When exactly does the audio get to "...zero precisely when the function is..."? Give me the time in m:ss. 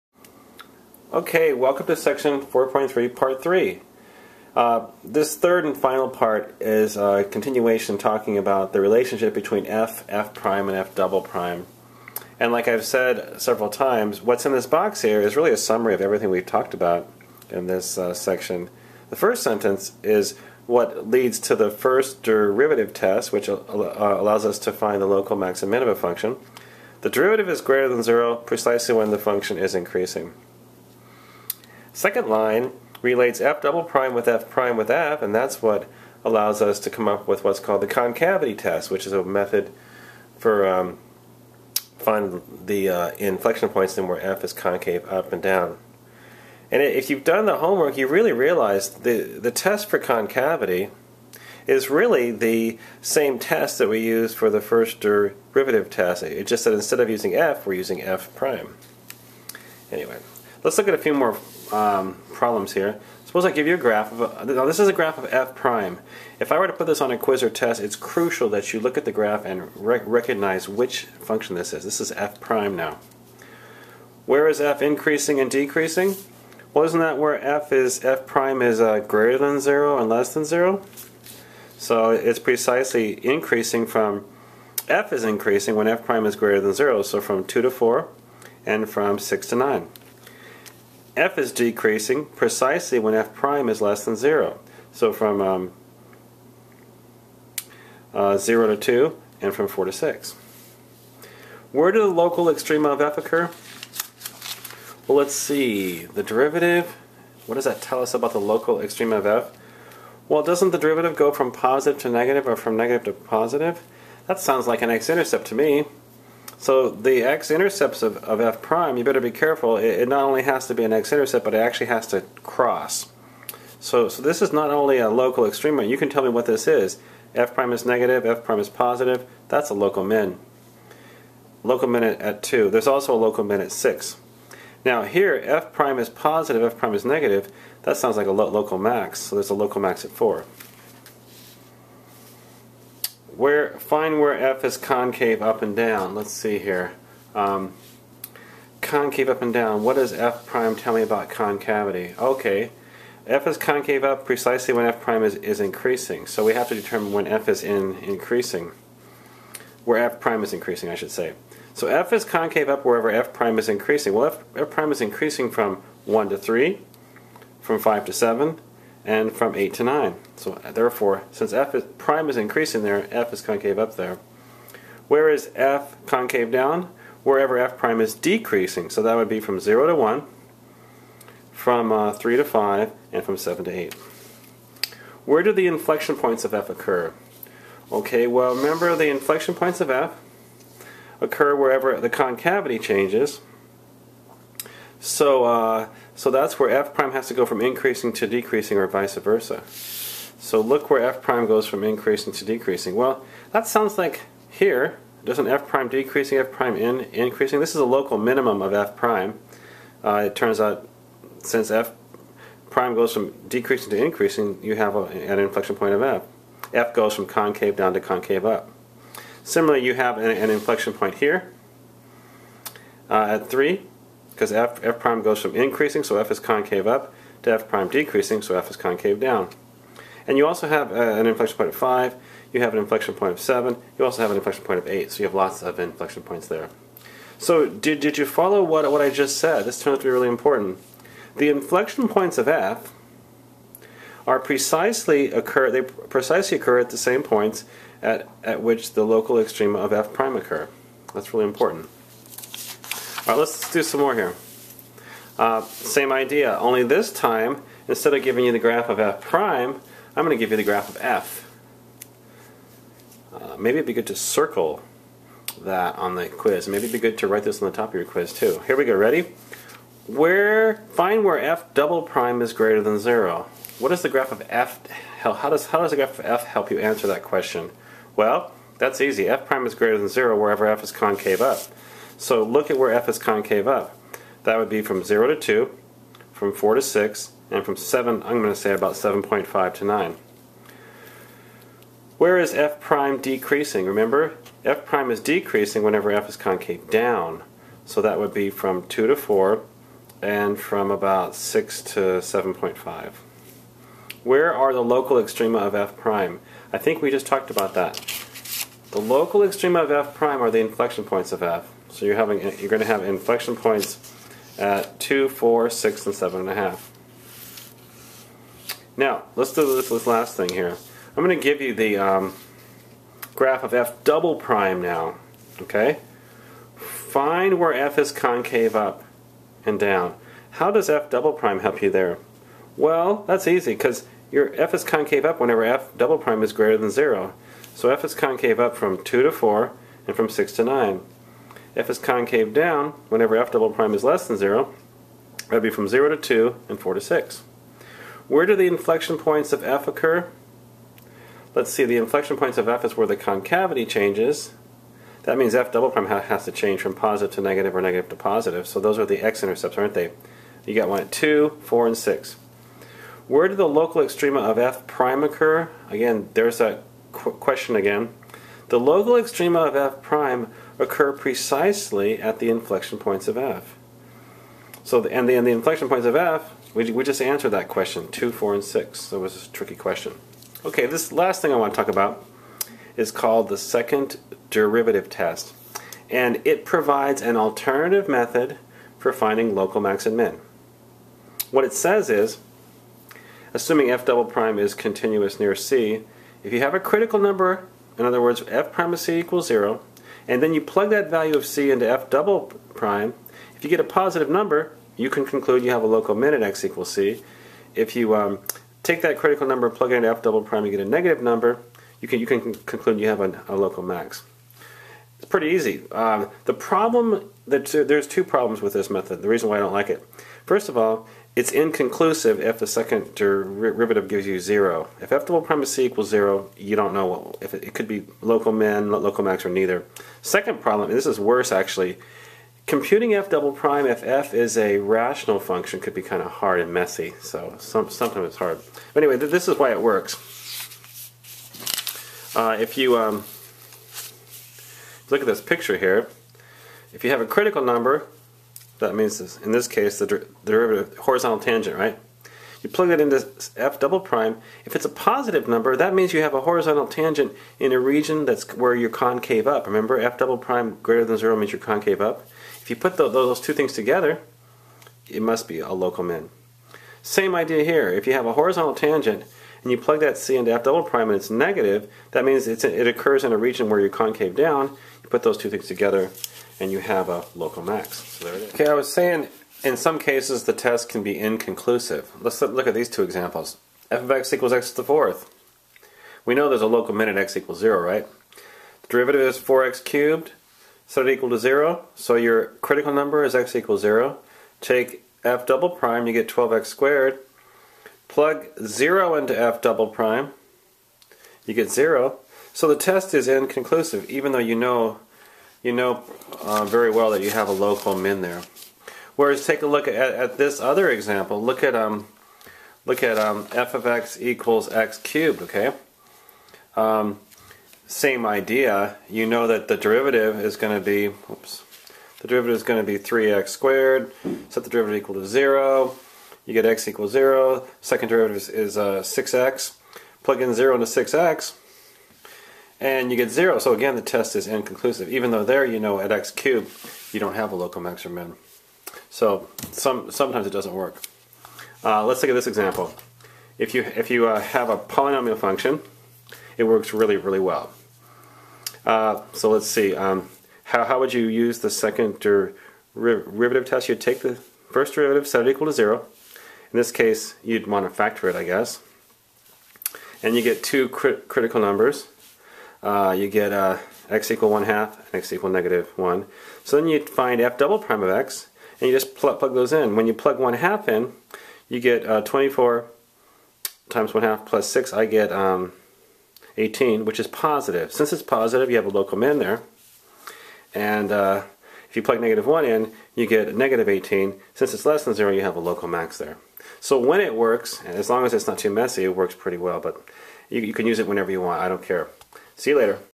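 0:28.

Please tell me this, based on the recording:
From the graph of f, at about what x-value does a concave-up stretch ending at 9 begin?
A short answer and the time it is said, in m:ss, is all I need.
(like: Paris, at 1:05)
7.5, at 4:48.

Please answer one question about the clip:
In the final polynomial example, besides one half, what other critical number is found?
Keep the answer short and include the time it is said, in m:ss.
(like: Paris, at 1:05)
-1, at 9:25.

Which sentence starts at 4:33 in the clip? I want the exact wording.
What does the graph of f, how does, how does the graph of f help you answer that question?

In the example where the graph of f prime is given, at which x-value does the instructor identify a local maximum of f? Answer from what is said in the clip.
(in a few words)
4.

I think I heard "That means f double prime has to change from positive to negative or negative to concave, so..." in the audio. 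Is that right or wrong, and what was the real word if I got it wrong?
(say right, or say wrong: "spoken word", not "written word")
wrong: "positive", not "concave".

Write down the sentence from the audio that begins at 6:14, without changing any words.
So, the, and, the, and the inflection points of f, we, we just answered that question, 2, 4, and 6.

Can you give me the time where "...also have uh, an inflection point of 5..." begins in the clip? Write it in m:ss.
3:50.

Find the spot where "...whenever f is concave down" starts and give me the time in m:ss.
4:55.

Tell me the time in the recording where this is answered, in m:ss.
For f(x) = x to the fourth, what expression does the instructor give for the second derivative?
8:16.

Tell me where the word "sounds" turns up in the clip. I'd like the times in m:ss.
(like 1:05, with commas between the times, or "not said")
1:54, 2:17, 3:23.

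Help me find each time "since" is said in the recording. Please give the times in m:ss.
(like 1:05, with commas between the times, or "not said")
2:51, 3:31, 9:37, 9:44.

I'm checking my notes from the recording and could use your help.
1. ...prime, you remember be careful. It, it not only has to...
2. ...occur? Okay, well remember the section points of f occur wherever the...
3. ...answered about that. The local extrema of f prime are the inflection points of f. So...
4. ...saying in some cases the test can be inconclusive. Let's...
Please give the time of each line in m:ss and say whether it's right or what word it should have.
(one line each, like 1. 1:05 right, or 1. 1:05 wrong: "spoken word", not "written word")
1. 1:58 wrong: "better", not "remember"
2. 3:06 wrong: "inflection", not "section"
3. 5:07 wrong: "talked", not "answered"
4. 7:58 right.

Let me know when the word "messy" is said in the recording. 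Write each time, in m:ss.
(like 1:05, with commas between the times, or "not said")
7:16, 9:48.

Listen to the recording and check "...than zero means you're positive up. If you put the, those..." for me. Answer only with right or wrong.
wrong.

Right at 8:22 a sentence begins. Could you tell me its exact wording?
So the test is inconclusive, even though you know you know uh, very well that you have a local min there.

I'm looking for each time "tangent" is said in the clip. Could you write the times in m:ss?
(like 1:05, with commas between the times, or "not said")
7:31, 7:36, 7:48.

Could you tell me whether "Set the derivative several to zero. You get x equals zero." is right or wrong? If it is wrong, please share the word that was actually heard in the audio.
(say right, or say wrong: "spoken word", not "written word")
wrong: "equal", not "several".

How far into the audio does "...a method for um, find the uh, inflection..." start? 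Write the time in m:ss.
0:39.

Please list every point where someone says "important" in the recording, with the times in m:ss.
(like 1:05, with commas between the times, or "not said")
4:00, 4:11.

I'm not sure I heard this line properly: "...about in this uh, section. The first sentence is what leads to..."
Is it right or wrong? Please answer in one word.
right.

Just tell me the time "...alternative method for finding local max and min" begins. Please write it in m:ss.
6:27.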